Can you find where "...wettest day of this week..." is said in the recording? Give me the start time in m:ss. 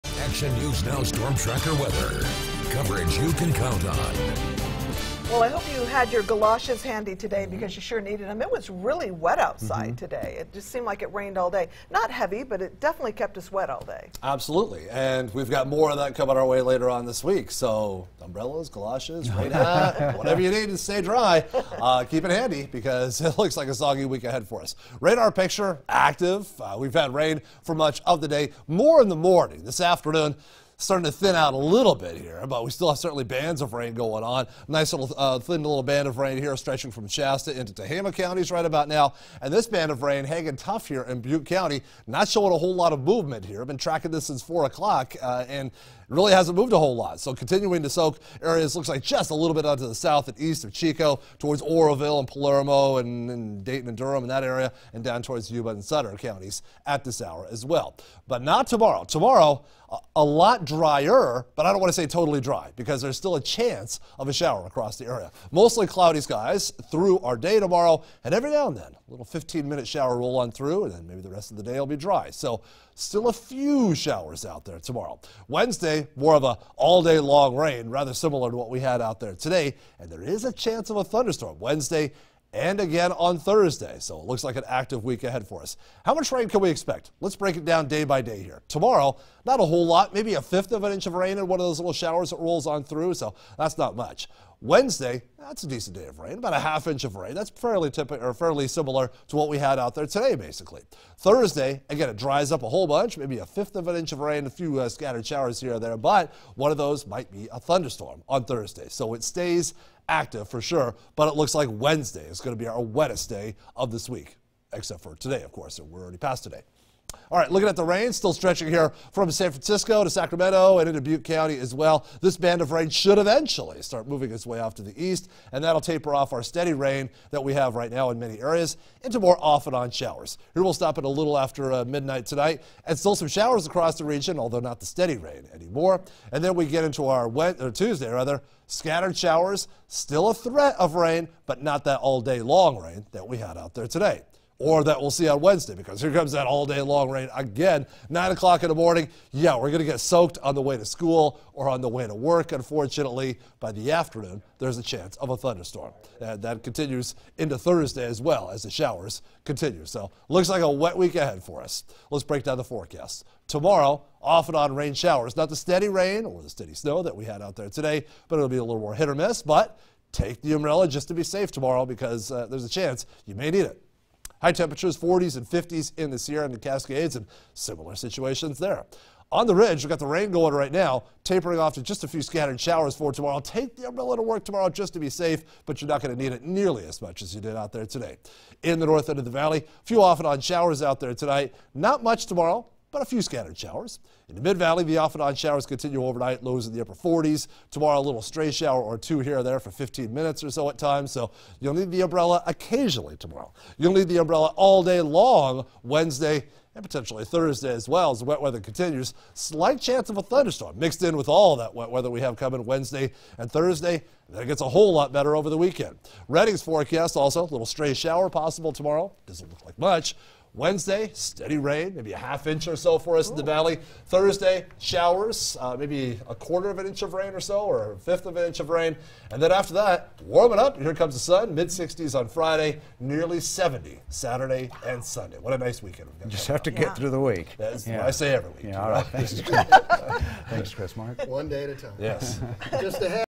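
1:52.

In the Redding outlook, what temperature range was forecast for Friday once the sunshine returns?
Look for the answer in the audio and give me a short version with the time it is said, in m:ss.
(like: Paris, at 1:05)
mid 60s, at 3:51.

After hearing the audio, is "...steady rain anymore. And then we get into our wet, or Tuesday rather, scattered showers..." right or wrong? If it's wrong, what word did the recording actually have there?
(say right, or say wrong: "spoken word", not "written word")
right.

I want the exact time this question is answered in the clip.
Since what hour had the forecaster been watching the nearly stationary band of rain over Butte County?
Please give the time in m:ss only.
0:44.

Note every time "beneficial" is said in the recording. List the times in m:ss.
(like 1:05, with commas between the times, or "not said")
not said.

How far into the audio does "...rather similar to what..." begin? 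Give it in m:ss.
1:17.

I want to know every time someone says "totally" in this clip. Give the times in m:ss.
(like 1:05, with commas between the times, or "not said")
1:02.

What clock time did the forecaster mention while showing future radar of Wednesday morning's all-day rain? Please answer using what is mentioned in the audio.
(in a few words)
9 o'clock.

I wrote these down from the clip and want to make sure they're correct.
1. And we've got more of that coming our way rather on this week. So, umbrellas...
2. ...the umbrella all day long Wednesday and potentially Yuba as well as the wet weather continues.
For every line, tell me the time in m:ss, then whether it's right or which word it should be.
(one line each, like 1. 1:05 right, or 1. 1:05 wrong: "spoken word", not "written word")
1. 0:14 wrong: "later", not "rather"
2. 3:24 wrong: "Thursday", not "Yuba".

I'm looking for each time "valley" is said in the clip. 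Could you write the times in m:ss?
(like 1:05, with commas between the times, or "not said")
3:09, 3:14, 3:43.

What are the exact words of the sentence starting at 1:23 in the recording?
So it looks like an active week ahead for us.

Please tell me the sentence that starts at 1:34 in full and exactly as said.
Wednesday, that's a decent day of rain, about a half inch of rain.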